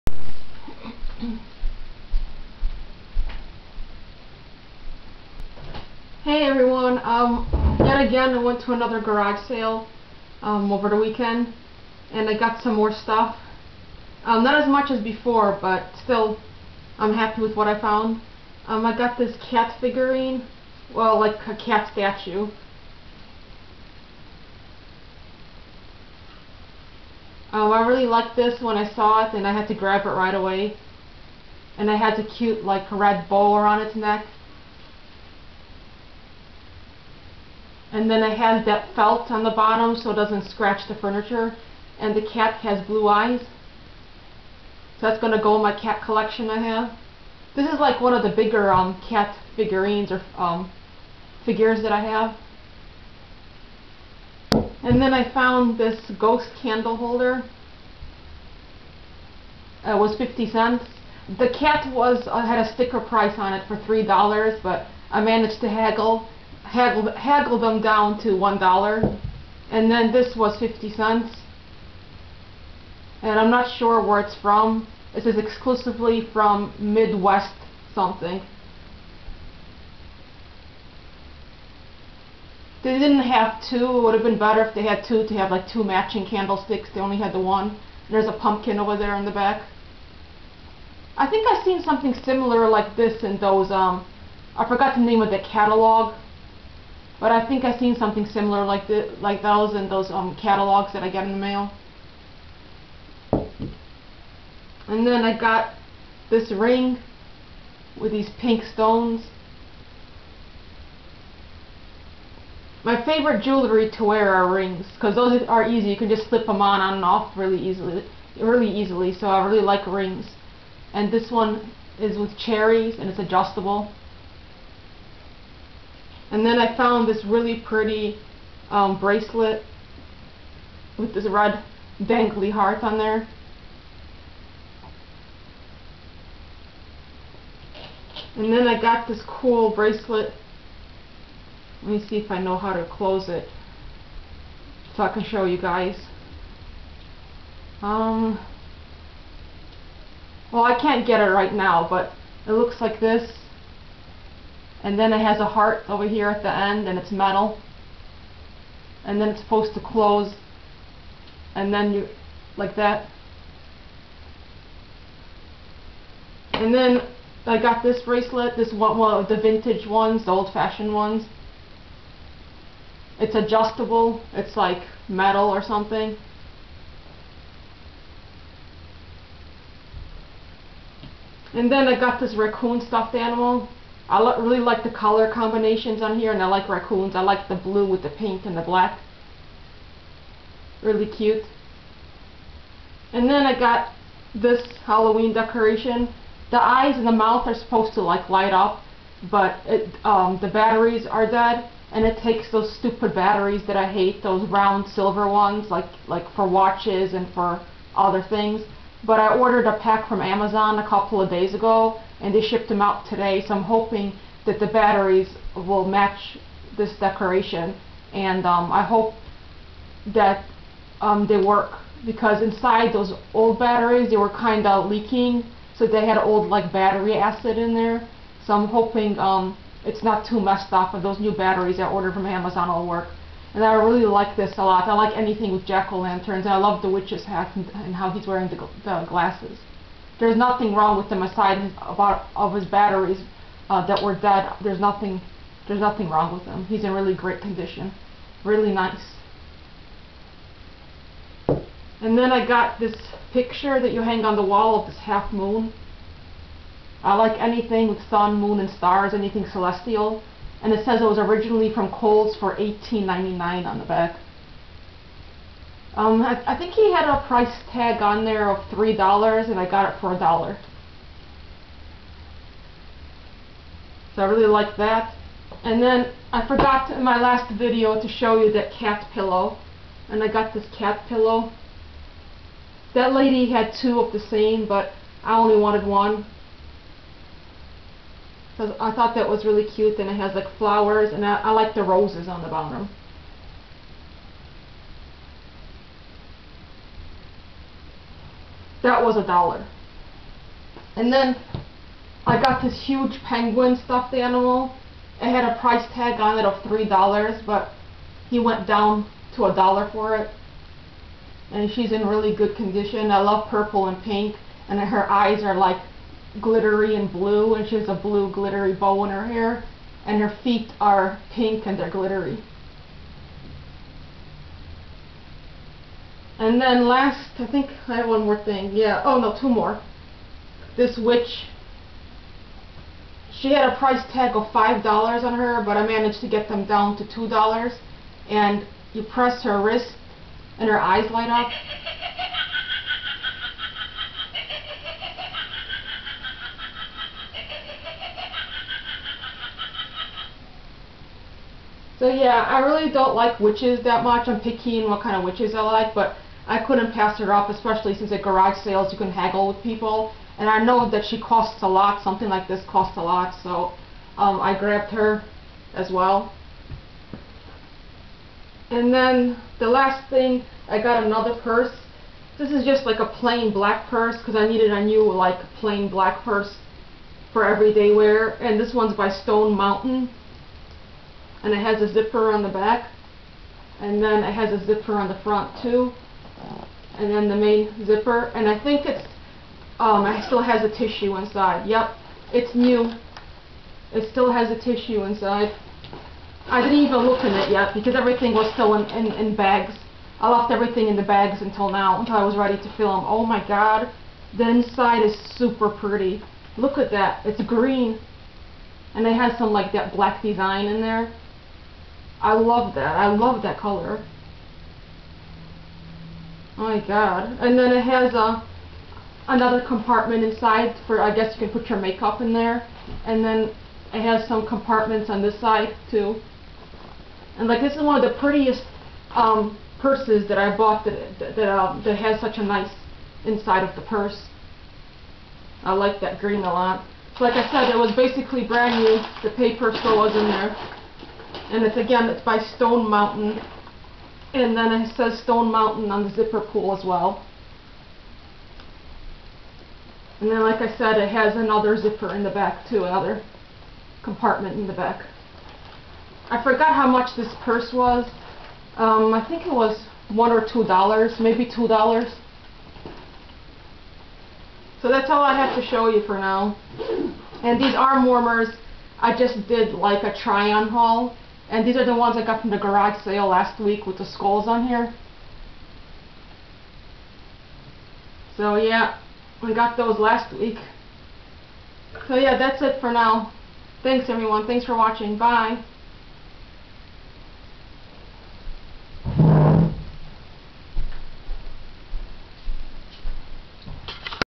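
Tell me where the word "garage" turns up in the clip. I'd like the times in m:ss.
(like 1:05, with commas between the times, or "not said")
0:08, 5:58, 7:52.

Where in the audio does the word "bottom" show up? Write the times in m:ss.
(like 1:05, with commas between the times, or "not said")
0:39, 4:52.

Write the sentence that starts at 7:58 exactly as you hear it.
So yeah, we got those last week.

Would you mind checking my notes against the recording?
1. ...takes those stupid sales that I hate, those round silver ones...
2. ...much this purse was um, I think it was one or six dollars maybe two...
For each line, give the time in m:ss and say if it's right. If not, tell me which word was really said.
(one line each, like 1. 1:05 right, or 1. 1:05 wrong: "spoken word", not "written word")
1. 3:22 wrong: "batteries", not "sales"
2. 7:36 wrong: "two", not "six".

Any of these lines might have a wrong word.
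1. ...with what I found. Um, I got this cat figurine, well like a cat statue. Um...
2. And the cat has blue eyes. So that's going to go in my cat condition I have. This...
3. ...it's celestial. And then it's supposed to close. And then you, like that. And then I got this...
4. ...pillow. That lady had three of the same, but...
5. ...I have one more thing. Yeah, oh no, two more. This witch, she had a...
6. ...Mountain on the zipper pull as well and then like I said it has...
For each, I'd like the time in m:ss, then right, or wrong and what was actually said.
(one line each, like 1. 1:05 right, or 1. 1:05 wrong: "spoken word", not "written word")
1. 0:17 right
2. 0:41 wrong: "collection", not "condition"
3. 2:36 wrong: "metal", not "celestial"
4. 4:41 wrong: "two", not "three"
5. 5:27 right
6. 7:25 right.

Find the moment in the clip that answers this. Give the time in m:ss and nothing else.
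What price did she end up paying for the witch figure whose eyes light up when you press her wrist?
5:37.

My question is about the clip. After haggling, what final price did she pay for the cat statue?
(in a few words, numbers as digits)
$1.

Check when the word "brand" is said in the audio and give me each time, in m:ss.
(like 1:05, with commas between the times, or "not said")
7:18.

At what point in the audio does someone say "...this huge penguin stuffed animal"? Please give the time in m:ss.
5:02.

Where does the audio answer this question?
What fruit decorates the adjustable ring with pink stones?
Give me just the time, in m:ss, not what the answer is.
2:02.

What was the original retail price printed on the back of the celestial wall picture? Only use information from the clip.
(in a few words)
$18.99.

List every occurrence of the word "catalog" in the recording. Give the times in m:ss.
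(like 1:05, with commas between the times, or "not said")
1:35, 1:40.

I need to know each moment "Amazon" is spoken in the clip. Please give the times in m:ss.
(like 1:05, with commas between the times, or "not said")
3:30, 3:52.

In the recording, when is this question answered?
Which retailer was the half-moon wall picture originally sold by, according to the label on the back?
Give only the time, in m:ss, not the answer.
4:21.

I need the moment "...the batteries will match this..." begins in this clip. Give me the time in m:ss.
3:34.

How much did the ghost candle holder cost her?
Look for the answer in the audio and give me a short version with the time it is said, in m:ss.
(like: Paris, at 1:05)
50 cents, at 1:10.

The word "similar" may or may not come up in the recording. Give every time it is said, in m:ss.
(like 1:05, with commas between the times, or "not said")
1:32, 1:38.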